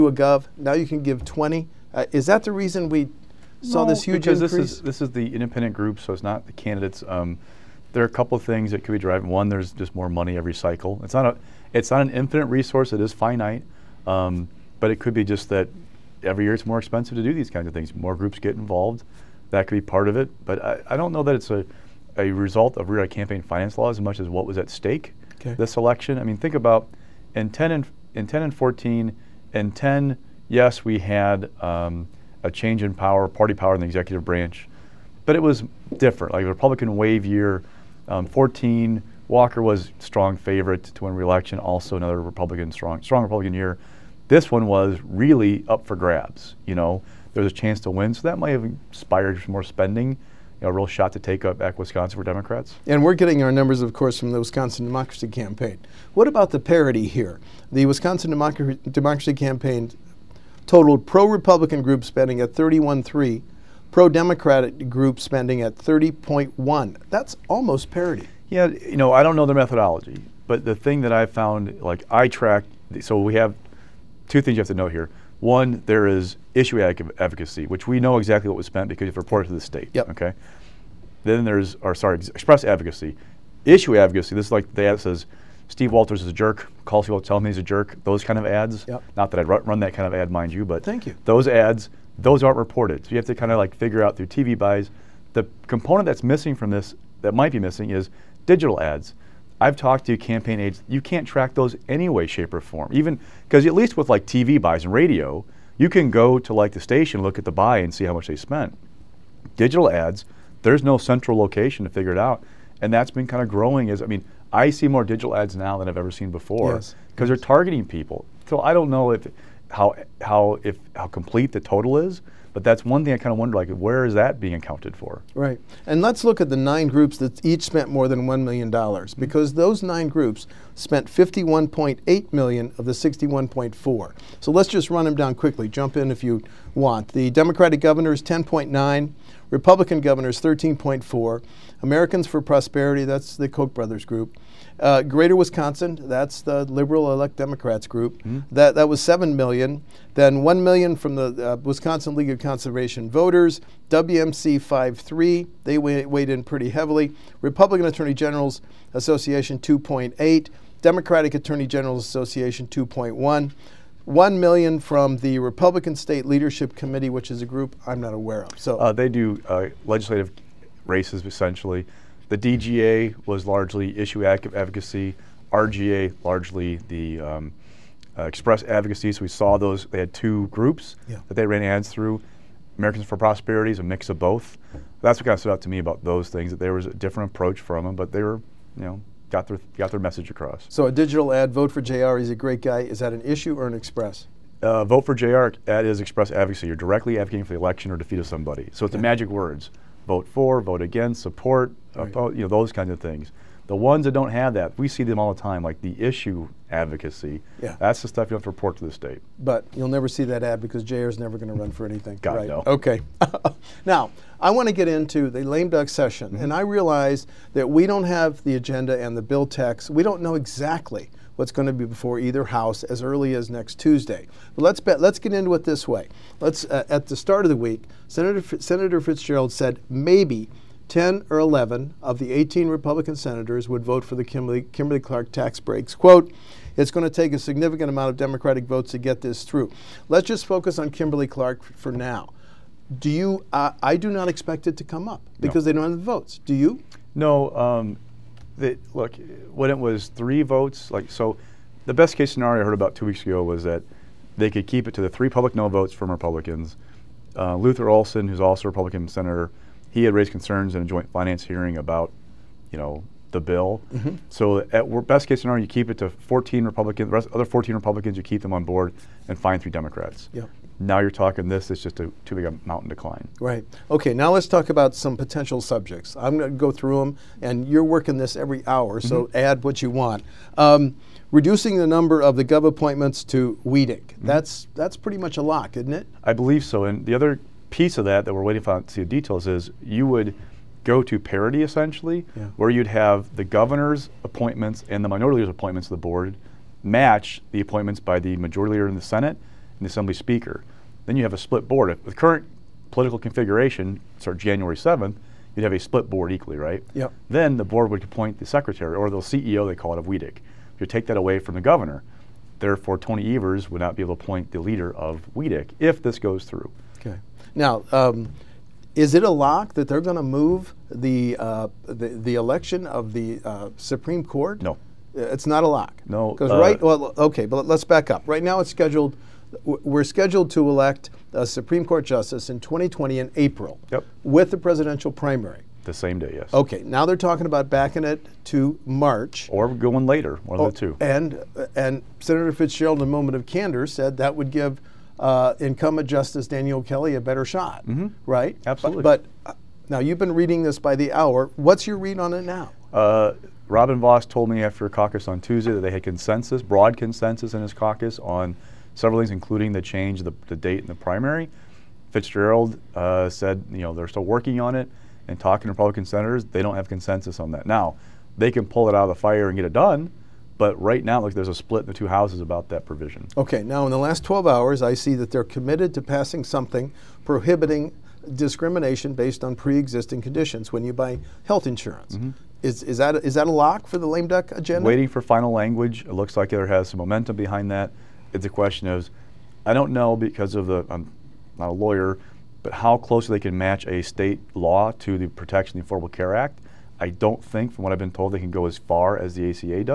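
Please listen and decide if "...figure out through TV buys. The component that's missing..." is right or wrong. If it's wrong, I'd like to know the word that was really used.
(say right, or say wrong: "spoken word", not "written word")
right.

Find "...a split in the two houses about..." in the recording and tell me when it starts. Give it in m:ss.
6:11.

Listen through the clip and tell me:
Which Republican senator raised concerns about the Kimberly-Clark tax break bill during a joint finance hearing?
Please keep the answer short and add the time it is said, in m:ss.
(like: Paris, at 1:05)
Luther Olsen, at 4:17.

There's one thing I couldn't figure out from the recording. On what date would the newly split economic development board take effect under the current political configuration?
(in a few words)
January 7.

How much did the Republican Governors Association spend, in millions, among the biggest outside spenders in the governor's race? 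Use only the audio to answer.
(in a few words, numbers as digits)
13.4 million.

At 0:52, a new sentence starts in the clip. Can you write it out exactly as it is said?
And we're getting our numbers, of course, from the Wisconsin Democracy Campaign.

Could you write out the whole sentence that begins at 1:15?
One, there is issue advocacy, which we know exactly what was spent because it's reported to the state.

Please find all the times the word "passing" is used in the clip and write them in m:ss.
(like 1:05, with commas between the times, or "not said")
6:16.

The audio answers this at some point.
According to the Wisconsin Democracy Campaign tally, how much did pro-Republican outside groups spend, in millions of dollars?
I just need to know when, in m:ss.
1:02.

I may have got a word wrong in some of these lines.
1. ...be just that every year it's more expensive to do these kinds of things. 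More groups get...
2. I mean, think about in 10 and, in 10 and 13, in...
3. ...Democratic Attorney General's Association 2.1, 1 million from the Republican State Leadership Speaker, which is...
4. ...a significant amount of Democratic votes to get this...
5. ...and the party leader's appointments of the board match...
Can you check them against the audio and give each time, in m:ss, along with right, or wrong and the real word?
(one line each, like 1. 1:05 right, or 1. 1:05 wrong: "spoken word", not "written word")
1. 0:15 right
2. 0:26 wrong: "14", not "13"
3. 2:40 wrong: "Committee", not "Speaker"
4. 3:57 right
5. 4:54 wrong: "minority", not "party".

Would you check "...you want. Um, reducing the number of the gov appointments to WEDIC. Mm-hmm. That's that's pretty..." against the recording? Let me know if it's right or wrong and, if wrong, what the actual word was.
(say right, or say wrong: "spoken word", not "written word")
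right.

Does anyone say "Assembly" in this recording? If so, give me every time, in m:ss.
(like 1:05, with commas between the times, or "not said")
4:59.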